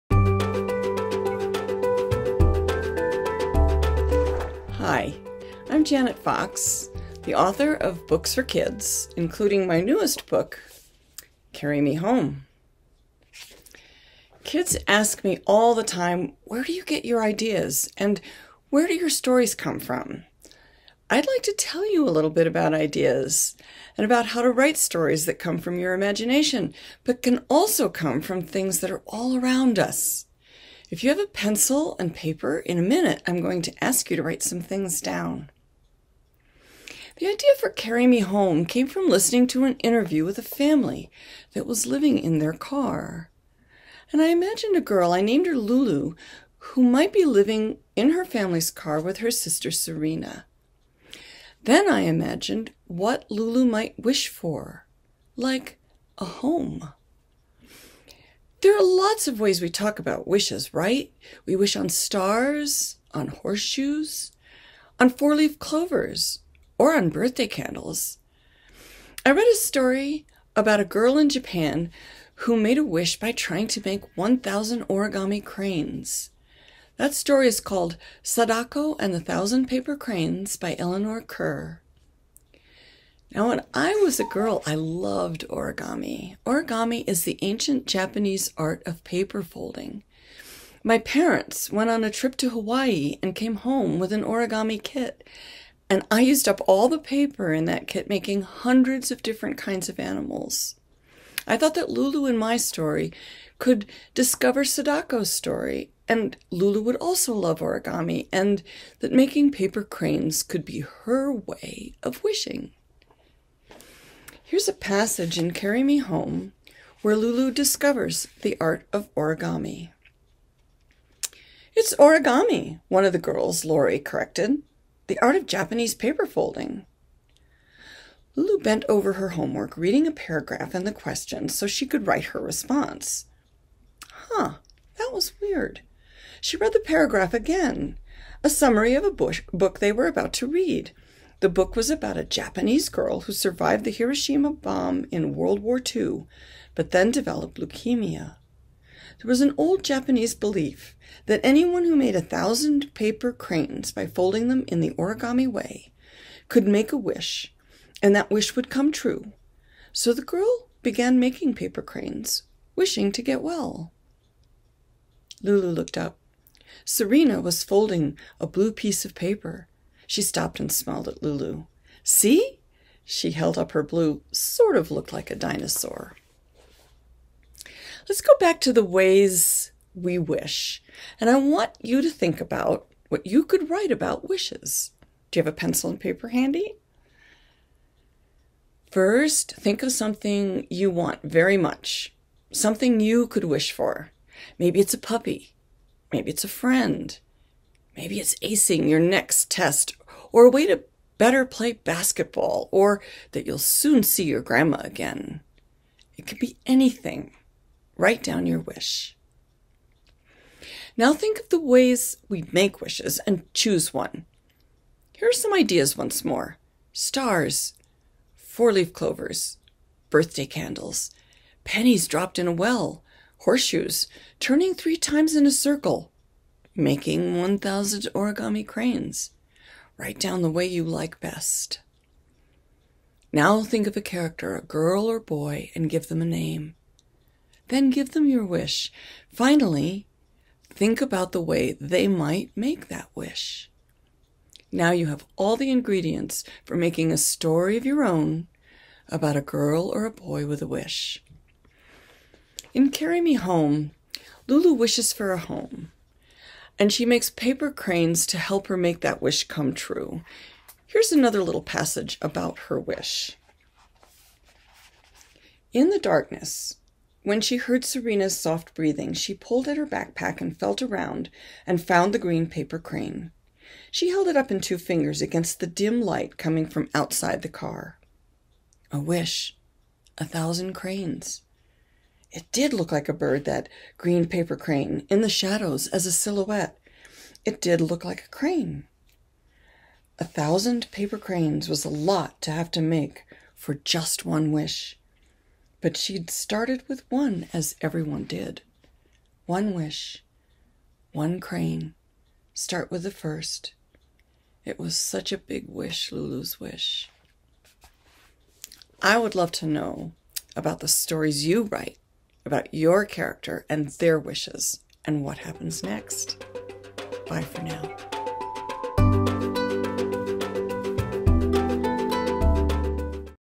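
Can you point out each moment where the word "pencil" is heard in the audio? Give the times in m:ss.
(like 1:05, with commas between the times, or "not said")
0:31, 3:05.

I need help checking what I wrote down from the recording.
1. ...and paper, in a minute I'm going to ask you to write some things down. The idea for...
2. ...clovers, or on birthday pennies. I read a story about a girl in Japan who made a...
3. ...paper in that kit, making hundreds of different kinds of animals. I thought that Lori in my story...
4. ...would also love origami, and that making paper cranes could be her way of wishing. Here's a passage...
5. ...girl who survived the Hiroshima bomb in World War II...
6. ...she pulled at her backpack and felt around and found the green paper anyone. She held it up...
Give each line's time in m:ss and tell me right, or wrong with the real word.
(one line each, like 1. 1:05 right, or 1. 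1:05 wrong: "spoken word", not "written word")
1. 0:31 right
2. 1:05 wrong: "candles", not "pennies"
3. 1:36 wrong: "Lulu", not "Lori"
4. 1:46 right
5. 2:22 right
6. 4:29 wrong: "crane", not "anyone".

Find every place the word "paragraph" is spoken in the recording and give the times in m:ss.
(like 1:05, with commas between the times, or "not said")
2:10, 2:16.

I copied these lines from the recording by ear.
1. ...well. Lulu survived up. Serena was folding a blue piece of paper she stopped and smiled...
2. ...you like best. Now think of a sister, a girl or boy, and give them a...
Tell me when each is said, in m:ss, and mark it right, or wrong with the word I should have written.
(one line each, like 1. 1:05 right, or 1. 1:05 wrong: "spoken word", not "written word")
1. 2:43 wrong: "looked", not "survived"
2. 3:50 wrong: "character", not "sister".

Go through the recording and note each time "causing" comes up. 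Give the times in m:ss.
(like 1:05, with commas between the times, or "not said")
not said.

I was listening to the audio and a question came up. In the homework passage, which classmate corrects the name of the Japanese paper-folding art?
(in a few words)
Lori.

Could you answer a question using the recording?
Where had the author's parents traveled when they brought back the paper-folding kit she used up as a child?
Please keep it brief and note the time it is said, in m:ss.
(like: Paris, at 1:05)
Hawaii, at 1:32.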